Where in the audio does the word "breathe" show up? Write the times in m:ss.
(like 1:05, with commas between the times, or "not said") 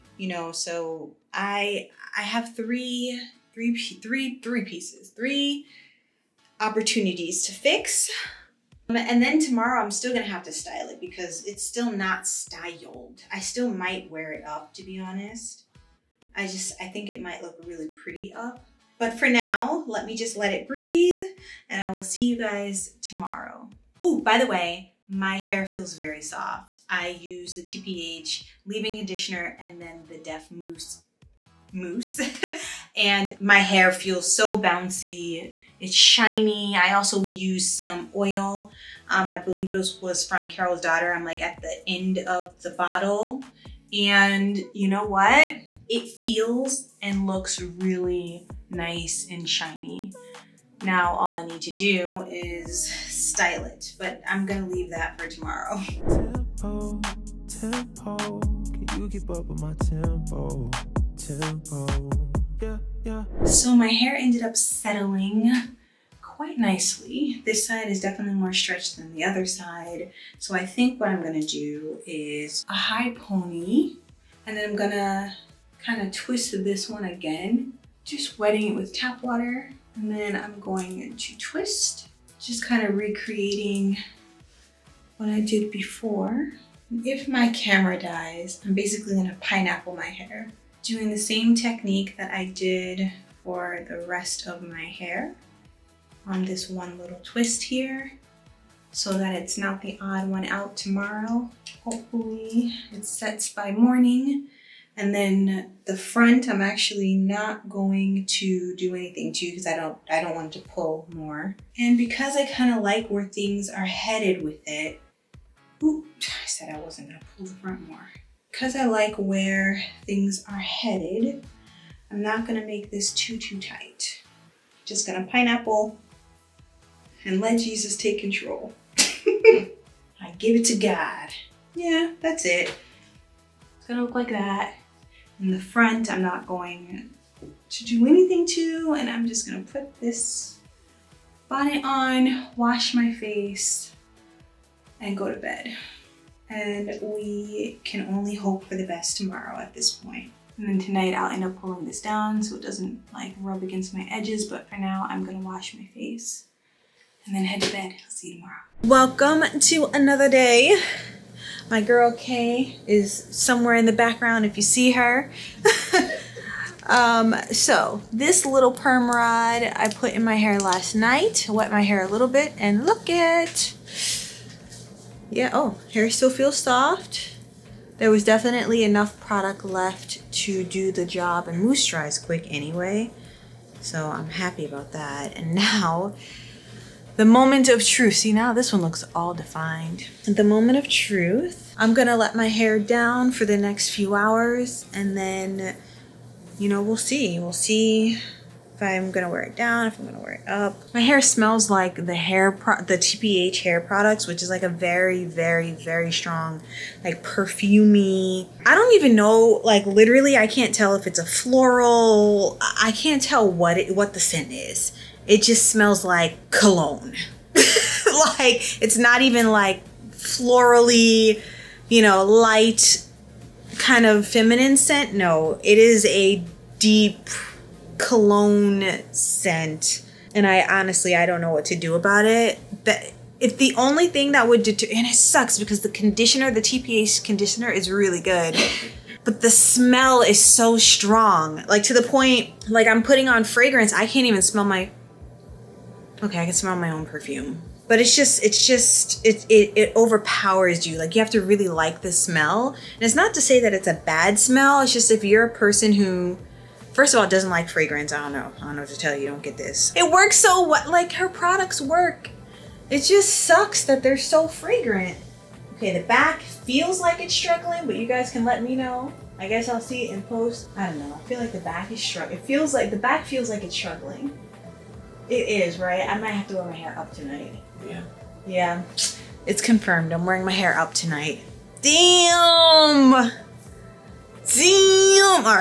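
0:20.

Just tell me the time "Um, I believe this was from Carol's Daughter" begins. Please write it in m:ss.
0:39.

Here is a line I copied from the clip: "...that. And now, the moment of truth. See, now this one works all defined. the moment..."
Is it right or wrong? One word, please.
wrong.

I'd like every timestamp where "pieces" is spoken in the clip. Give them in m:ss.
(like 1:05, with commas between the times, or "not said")
0:04.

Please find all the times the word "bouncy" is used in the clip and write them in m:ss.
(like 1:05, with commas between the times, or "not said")
0:34.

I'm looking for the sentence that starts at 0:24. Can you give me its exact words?
Oh, by the way, my hair feels very soft.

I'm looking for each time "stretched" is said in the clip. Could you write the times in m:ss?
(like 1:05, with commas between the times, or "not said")
1:08.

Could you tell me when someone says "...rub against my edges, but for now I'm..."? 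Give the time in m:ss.
2:33.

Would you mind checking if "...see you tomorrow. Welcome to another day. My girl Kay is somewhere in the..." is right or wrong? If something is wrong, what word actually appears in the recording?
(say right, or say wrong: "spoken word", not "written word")
right.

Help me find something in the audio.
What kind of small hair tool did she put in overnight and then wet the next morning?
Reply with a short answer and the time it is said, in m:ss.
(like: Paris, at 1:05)
perm rod, at 2:48.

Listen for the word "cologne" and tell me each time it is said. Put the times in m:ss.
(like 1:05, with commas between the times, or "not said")
3:36, 3:48.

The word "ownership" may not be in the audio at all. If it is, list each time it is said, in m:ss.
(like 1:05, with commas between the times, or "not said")
not said.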